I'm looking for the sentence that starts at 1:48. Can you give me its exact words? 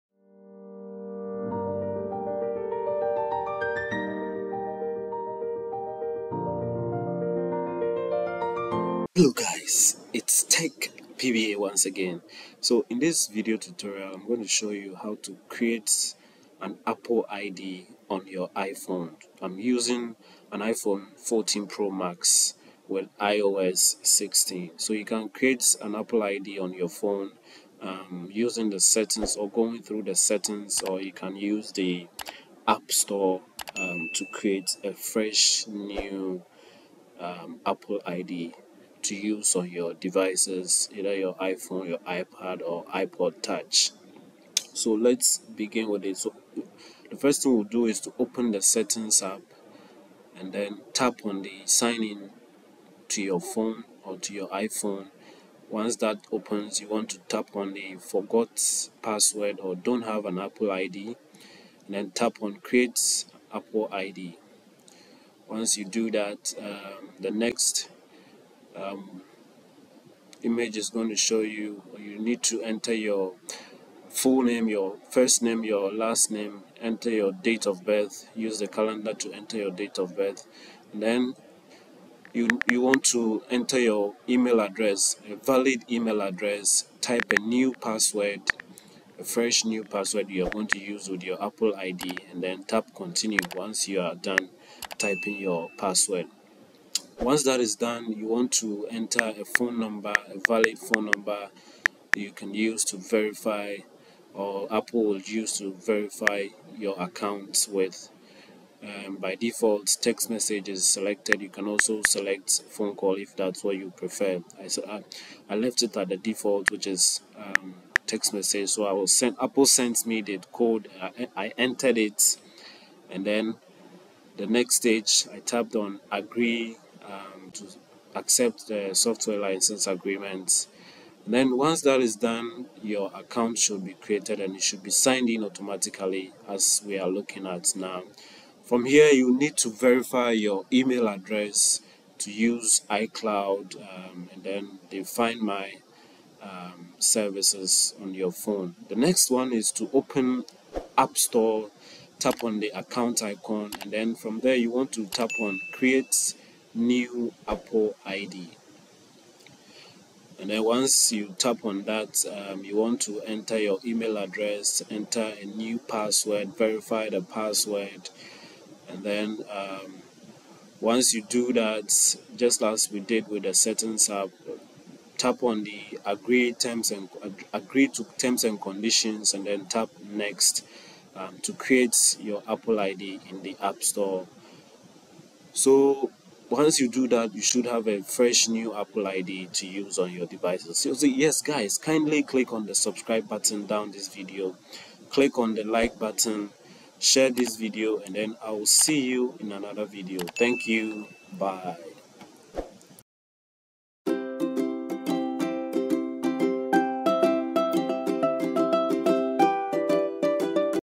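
Um, by default, text message is selected.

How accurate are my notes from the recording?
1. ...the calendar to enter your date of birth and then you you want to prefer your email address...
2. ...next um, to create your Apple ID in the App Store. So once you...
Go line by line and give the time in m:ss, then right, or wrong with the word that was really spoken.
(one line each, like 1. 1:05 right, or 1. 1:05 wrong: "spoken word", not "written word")
1. 1:18 wrong: "enter", not "prefer"
2. 3:00 right.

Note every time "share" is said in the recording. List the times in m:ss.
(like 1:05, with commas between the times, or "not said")
3:16.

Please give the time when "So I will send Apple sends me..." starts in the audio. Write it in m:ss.
1:58.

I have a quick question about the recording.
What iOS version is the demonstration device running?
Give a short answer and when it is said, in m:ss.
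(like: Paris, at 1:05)
iOS 16, at 0:23.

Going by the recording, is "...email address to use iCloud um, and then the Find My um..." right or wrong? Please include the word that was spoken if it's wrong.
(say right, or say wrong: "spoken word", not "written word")
right.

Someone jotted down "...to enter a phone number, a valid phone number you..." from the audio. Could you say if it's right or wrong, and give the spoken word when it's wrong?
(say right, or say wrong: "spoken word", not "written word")
right.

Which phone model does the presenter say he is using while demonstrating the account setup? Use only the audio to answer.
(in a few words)
iPhone 14 Pro Max.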